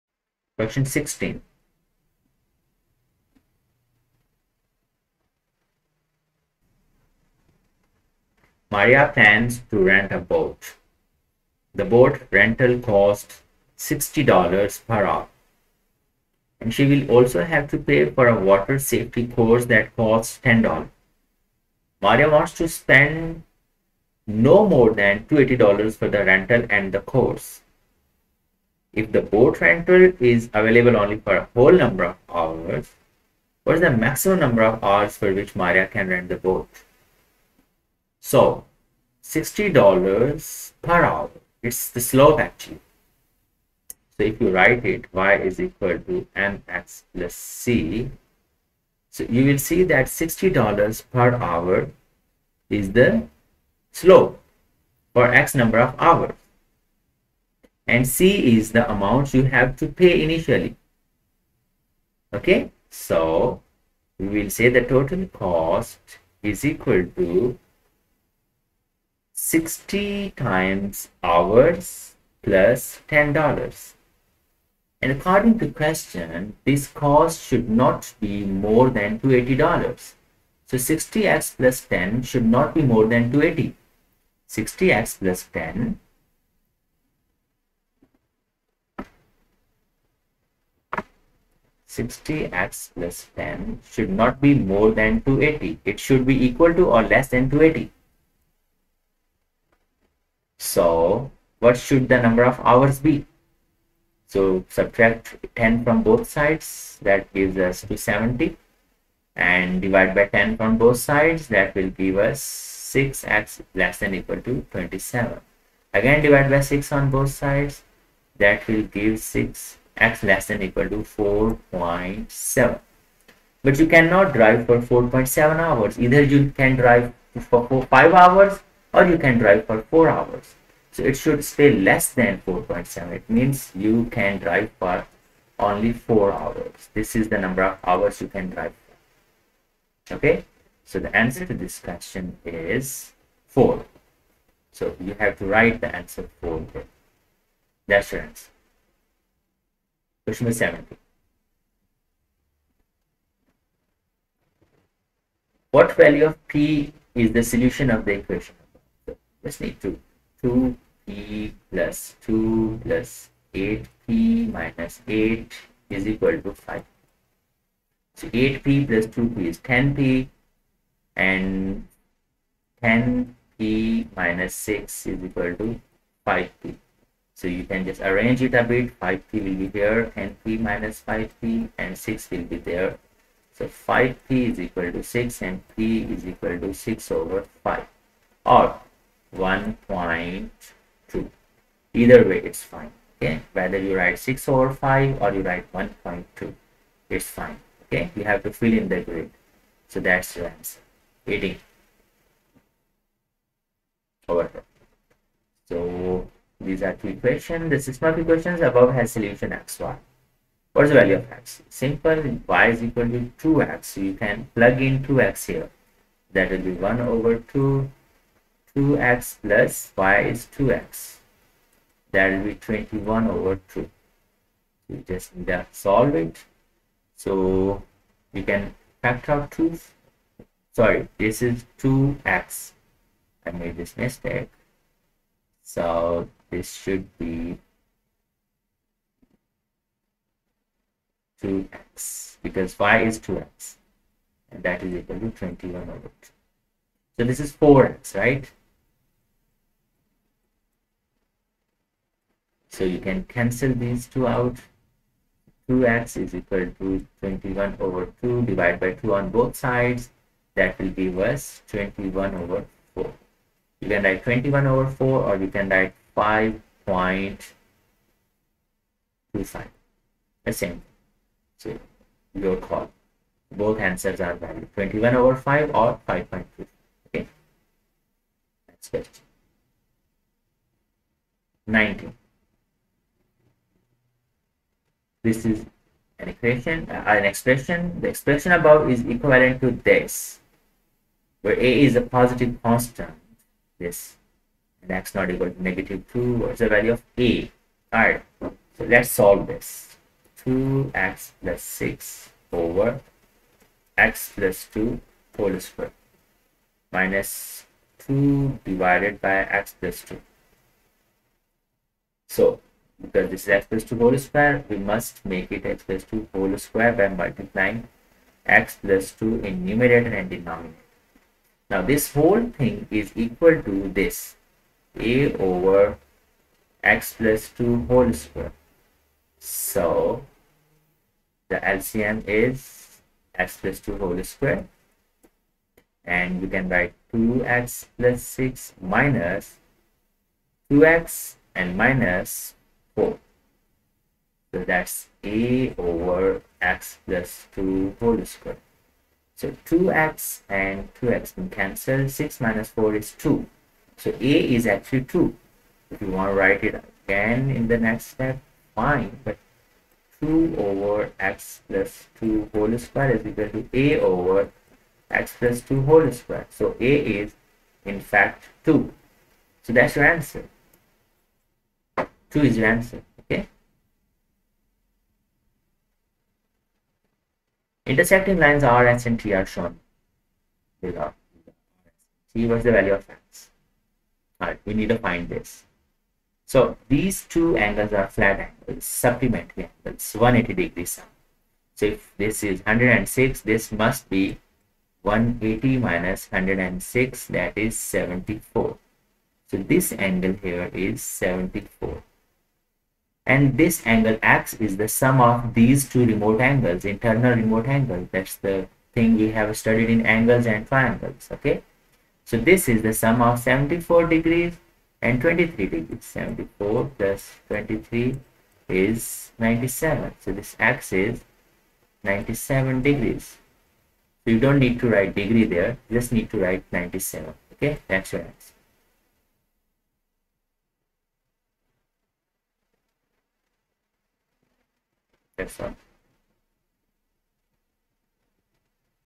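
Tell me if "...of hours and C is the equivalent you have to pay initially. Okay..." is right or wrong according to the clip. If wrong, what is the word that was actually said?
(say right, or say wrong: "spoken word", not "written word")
wrong: "amount", not "equivalent".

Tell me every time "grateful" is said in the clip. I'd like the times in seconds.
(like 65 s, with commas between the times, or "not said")
not said.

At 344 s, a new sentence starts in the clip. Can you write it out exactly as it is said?
So that's a over x plus 2 whole square.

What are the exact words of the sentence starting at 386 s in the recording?
So these two angles are flat angles, supplementary angles, 180 degrees.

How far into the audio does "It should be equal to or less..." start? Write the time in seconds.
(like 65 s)
95 s.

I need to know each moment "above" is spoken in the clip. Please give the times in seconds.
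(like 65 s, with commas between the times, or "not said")
208 s, 288 s.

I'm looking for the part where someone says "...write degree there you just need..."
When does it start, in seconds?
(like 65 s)
424 s.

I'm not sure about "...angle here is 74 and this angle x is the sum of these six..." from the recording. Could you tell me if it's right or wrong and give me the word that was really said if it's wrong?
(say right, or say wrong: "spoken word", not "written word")
wrong: "two", not "six".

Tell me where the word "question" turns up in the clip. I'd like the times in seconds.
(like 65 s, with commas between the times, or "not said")
0 s, 75 s, 141 s, 150 s, 278 s.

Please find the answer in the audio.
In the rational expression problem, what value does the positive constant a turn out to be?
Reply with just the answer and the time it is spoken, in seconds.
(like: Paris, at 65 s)
2, at 366 s.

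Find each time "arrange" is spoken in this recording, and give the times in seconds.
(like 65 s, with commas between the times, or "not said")
178 s.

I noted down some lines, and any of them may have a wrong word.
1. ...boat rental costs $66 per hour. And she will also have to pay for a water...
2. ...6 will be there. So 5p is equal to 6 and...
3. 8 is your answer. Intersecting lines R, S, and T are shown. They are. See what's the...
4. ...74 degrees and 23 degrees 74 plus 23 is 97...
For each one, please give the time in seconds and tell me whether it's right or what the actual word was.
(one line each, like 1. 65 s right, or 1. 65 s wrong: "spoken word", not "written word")
1. 11 s wrong: "60", not "66"
2. 181 s right
3. 372 s wrong: "2", not "8"
4. 413 s right.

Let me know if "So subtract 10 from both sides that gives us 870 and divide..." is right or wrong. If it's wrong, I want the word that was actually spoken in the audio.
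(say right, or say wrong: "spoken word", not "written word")
wrong: "270", not "870".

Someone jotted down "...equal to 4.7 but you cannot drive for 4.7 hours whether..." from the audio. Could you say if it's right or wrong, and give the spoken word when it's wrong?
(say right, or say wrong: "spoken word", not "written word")
wrong: "either", not "whether".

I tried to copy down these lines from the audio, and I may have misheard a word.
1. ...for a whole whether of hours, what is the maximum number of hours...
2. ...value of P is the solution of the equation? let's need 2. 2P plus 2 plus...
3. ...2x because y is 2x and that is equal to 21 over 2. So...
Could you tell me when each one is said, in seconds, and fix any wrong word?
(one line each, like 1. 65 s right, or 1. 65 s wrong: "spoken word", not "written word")
1. 31 s wrong: "number", not "whether"
2. 155 s right
3. 241 s right.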